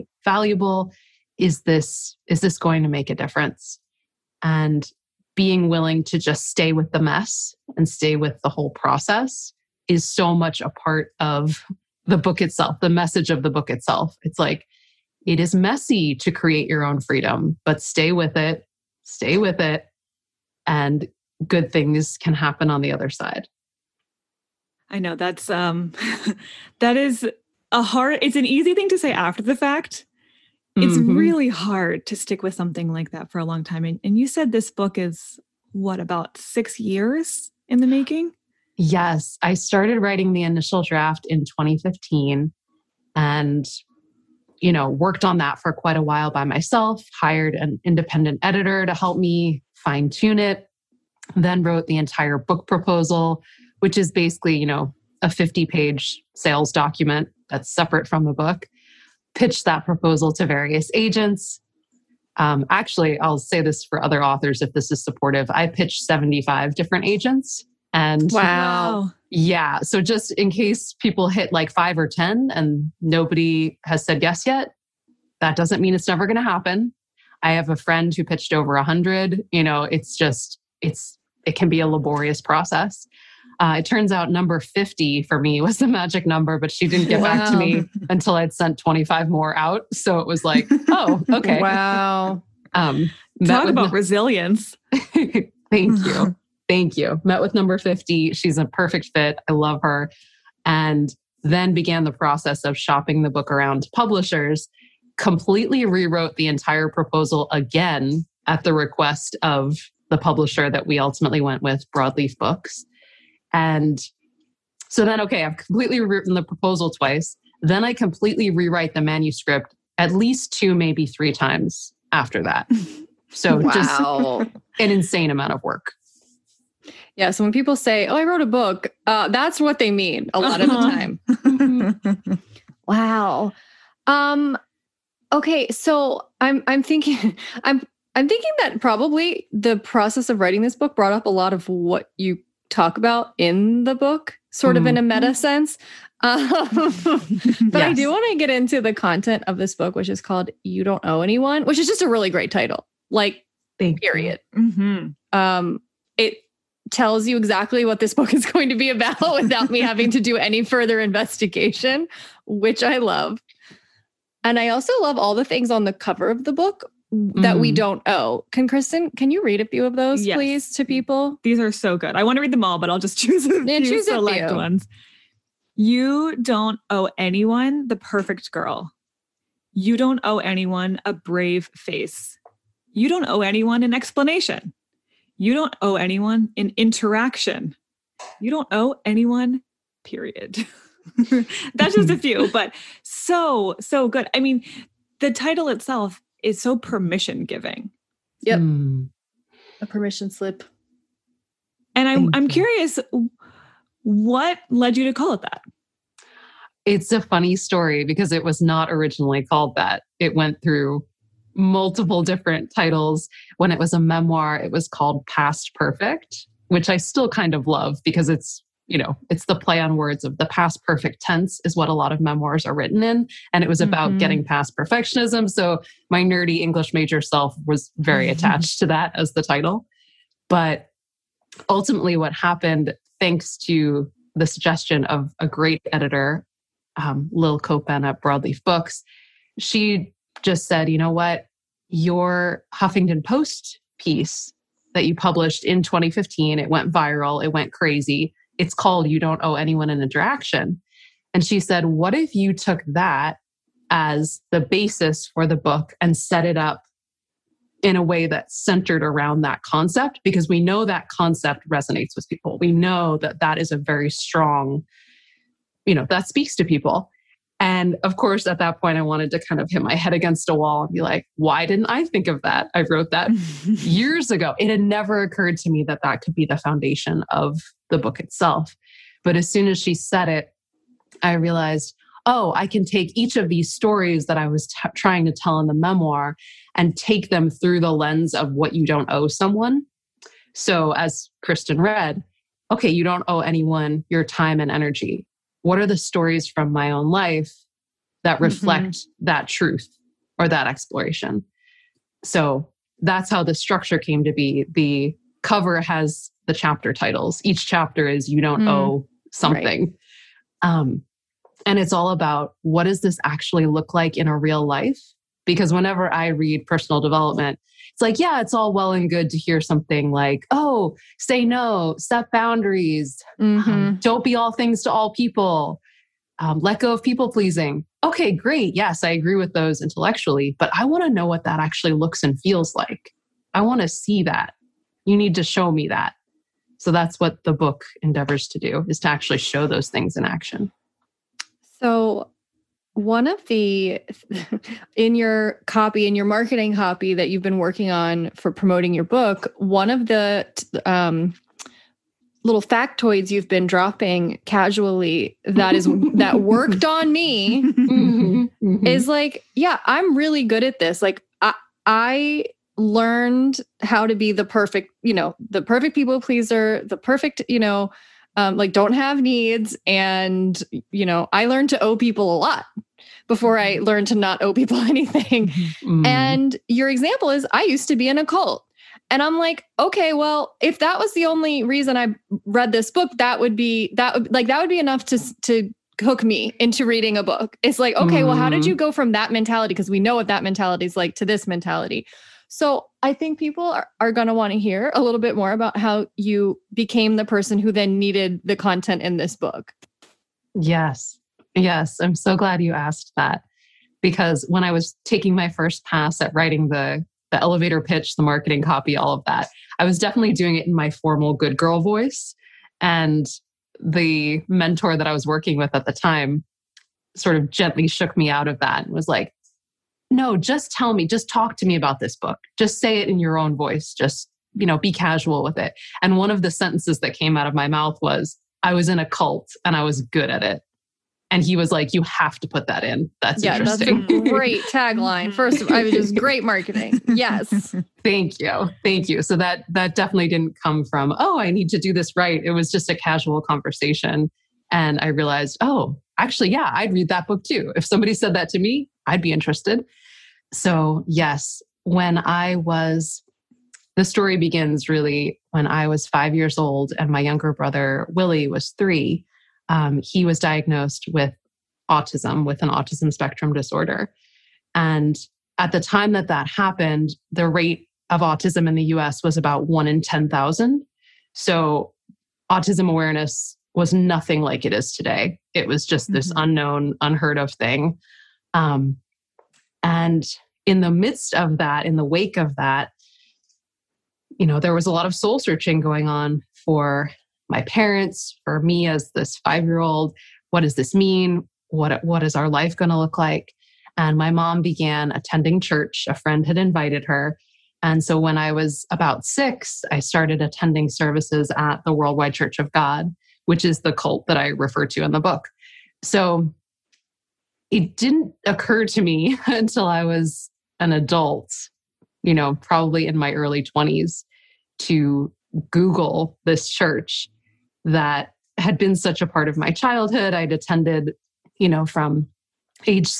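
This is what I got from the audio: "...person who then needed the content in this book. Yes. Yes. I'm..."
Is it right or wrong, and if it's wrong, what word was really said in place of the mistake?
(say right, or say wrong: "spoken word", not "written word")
right.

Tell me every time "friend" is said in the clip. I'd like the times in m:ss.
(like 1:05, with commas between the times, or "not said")
1:17, 8:16.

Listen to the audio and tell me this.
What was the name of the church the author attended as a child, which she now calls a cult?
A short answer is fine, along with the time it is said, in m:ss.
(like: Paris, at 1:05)
Worldwide Church of God, at 8:21.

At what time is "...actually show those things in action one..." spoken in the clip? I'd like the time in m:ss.
5:39.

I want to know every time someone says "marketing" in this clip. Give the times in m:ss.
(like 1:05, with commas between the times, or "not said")
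5:46, 6:48, 7:16.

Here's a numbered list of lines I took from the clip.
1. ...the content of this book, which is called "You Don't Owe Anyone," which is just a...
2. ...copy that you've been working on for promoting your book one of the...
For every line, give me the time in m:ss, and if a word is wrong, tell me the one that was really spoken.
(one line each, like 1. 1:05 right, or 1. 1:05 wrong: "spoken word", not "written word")
1. 2:28 right
2. 5:46 right.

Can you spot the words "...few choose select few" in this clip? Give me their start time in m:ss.
2:53.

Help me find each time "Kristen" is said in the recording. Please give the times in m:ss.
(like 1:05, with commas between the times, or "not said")
2:48, 4:51.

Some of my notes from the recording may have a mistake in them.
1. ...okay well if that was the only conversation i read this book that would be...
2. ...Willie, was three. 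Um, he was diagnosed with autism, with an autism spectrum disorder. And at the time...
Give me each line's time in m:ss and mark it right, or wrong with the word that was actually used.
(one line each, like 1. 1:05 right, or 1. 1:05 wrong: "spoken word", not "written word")
1. 6:19 wrong: "reason", not "conversation"
2. 7:38 right.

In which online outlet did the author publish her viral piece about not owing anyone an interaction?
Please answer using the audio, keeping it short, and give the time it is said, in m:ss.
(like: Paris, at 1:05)
Huffington Post, at 4:02.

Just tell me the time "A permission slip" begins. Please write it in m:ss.
3:19.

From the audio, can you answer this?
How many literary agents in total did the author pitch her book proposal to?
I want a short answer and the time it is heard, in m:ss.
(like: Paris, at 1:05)
75, at 1:06.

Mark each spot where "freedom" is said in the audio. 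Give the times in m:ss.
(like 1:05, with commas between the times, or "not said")
0:17.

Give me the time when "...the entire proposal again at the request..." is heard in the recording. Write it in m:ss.
1:46.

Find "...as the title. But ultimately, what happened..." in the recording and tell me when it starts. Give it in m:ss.
3:49.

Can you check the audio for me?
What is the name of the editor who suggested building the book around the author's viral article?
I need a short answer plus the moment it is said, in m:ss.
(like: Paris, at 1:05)
Lil Copan, at 3:57.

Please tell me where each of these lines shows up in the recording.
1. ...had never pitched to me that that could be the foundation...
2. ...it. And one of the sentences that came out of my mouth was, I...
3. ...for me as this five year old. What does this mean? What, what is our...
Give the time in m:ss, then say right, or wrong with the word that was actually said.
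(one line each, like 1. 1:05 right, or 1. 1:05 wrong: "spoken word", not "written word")
1. 4:34 wrong: "occurred", not "pitched"
2. 7:05 right
3. 8:08 right.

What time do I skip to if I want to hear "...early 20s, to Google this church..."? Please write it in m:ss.
8:33.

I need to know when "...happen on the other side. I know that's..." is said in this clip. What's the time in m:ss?
0:22.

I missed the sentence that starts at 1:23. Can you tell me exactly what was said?
Uh, it turns out number 50 for me was the magic number, but she didn't get wow.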